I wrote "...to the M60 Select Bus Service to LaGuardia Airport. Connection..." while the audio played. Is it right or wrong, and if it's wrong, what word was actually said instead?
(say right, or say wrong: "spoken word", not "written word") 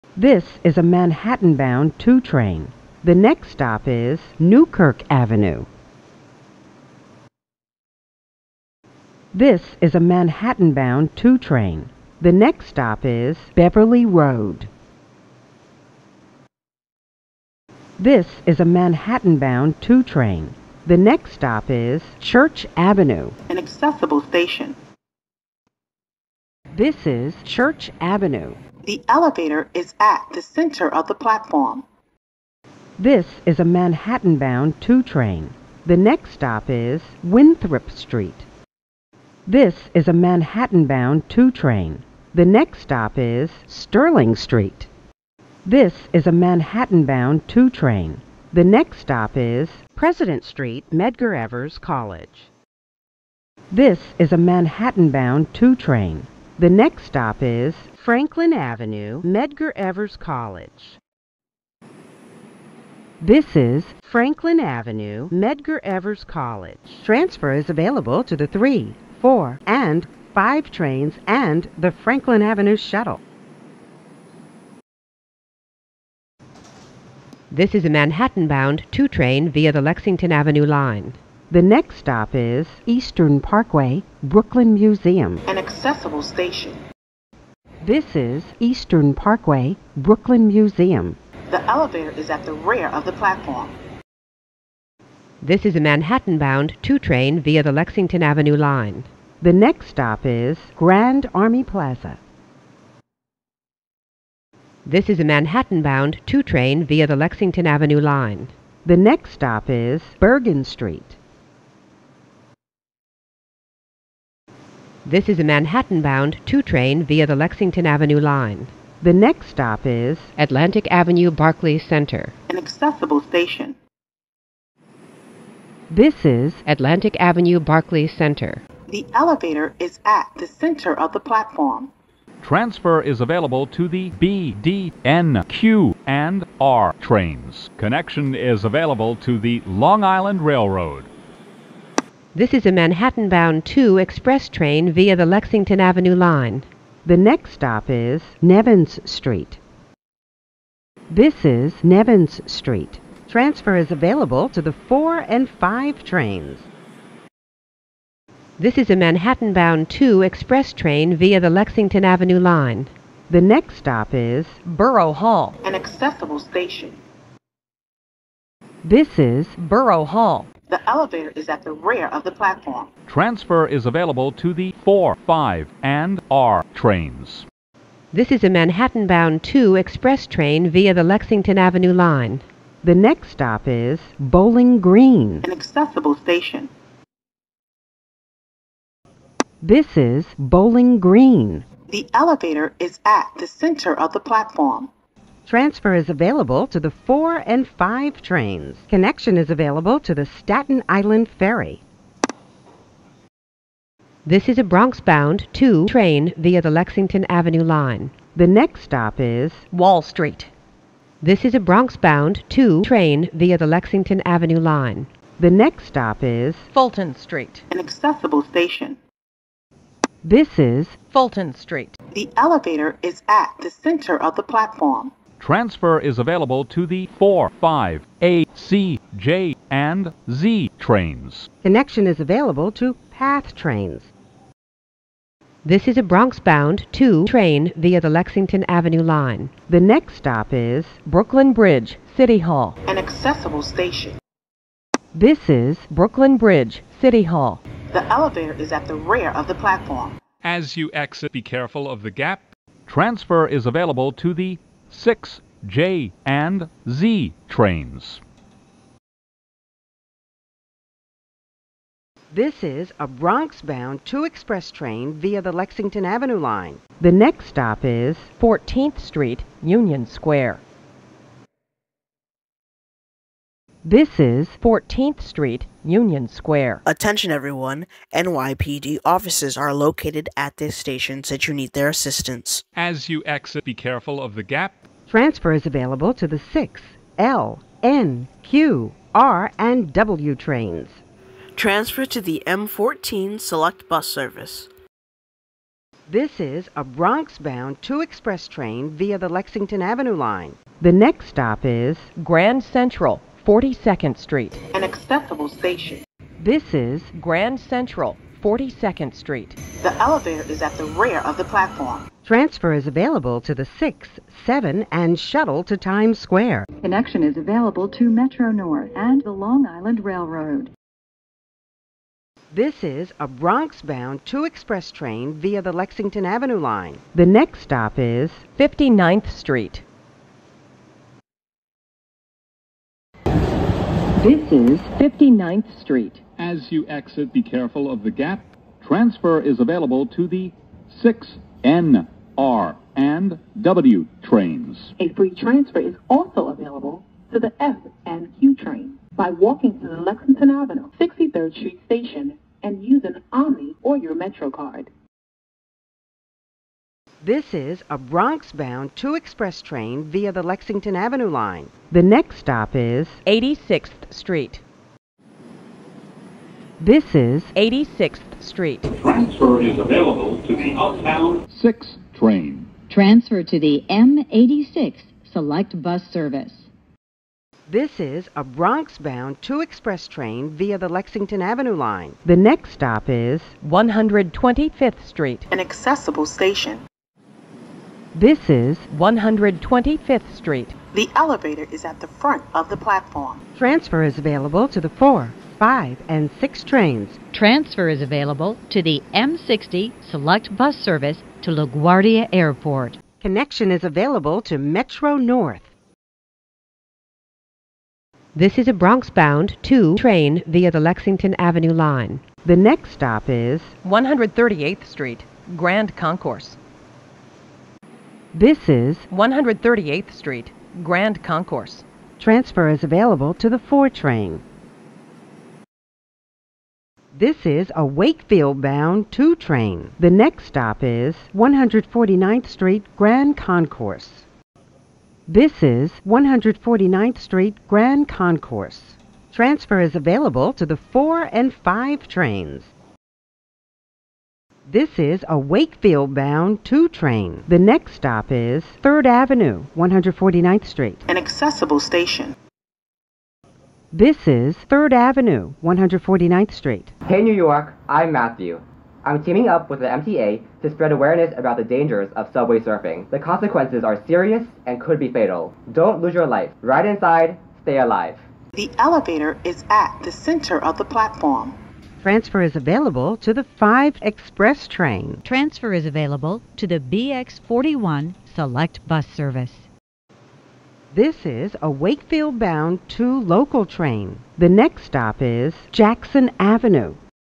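right.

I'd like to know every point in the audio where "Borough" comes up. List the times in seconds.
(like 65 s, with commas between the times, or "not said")
164 s, 169 s.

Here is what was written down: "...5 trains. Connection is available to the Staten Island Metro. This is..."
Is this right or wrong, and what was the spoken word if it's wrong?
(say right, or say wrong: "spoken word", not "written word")
wrong: "Ferry", not "Metro".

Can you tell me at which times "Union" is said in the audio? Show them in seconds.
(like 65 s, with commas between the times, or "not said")
269 s, 275 s.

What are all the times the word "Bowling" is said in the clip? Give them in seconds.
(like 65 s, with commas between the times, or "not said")
184 s, 190 s.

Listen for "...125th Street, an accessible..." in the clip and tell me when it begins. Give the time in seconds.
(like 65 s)
383 s.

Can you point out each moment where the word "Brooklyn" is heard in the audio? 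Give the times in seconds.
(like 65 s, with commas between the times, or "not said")
84 s, 89 s, 241 s, 245 s.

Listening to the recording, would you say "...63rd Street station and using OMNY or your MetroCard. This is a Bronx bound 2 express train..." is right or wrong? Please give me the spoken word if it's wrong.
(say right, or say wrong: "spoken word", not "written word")
right.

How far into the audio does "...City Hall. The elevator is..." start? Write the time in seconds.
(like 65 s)
246 s.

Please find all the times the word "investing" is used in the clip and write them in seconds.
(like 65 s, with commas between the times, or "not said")
not said.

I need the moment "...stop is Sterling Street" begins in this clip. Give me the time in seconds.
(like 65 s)
42 s.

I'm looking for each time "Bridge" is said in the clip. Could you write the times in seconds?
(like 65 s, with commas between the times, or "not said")
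241 s, 246 s.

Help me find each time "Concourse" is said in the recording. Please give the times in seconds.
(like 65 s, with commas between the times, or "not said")
415 s, 421 s, 433 s, 438 s.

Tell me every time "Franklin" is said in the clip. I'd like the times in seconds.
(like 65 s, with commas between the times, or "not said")
57 s, 64 s, 71 s.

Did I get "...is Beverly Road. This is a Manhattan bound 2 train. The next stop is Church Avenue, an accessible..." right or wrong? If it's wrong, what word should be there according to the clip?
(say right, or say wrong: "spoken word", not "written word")
right.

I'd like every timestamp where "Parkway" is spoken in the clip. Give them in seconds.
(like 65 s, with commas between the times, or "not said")
83 s, 89 s.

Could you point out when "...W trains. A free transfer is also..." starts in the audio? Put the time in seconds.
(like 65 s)
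343 s.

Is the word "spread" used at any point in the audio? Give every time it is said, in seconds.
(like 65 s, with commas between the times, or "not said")
460 s.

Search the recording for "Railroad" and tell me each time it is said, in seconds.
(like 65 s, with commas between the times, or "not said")
140 s, 320 s.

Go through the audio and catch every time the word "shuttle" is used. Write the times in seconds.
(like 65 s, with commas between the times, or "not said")
72 s, 315 s.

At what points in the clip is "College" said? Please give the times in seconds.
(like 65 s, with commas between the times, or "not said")
51 s, 60 s, 66 s.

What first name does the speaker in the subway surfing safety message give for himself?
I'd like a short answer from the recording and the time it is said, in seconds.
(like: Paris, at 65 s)
Matthew, at 458 s.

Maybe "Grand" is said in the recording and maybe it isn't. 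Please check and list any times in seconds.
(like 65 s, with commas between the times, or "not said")
100 s, 302 s, 307 s, 415 s, 420 s, 432 s, 437 s.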